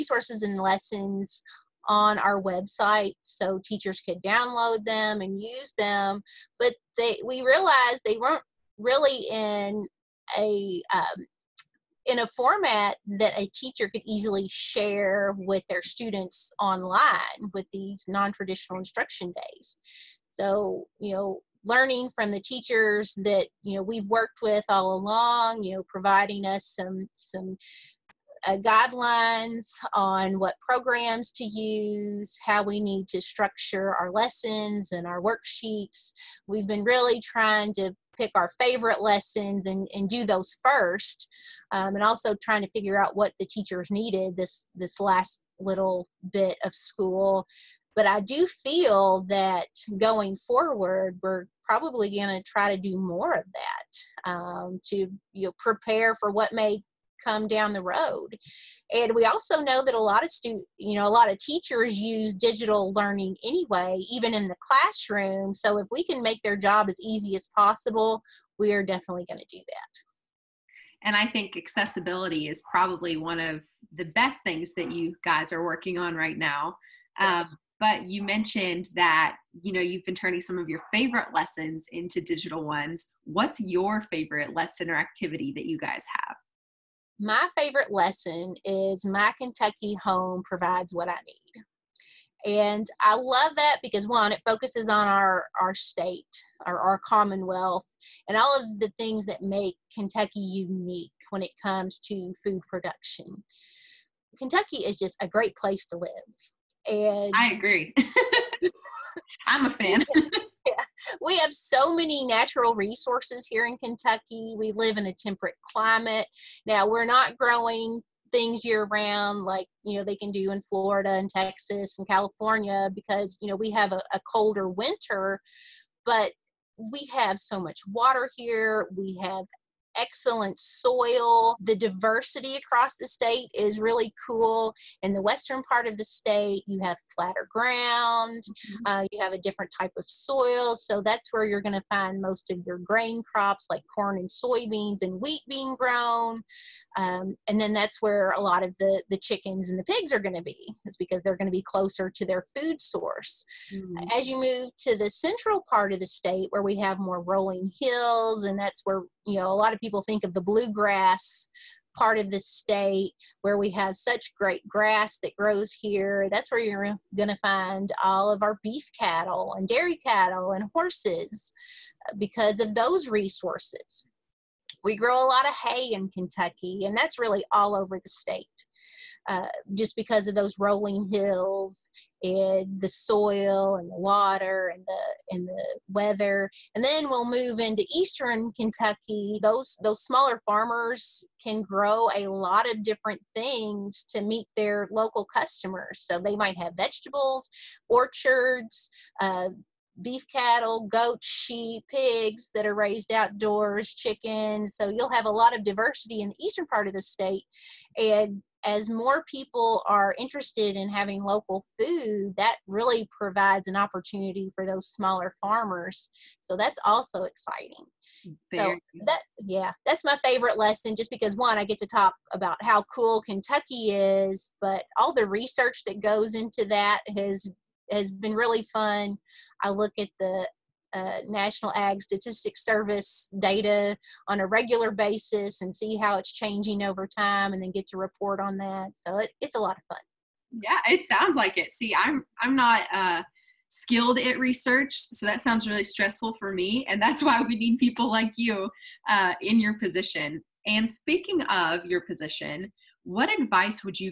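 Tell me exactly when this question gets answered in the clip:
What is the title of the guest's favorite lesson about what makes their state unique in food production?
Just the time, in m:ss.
1:29.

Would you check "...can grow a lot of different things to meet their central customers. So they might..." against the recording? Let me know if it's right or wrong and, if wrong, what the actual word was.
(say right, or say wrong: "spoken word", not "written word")
wrong: "local", not "central".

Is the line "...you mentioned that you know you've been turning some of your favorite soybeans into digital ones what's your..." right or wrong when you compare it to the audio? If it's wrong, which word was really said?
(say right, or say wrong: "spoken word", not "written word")
wrong: "lessons", not "soybeans".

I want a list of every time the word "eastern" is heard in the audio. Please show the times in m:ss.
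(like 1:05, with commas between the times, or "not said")
3:07, 3:26.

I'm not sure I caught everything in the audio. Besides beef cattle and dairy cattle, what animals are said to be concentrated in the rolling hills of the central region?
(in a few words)
horses.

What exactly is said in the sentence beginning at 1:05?
So if we can make their job as easy as possible, we are definitely going to do that.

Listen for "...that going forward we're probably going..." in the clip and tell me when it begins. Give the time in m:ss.
0:49.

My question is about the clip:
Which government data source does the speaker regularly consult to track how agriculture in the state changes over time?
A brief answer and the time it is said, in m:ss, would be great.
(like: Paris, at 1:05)
National Ag Statistics Service, at 3:51.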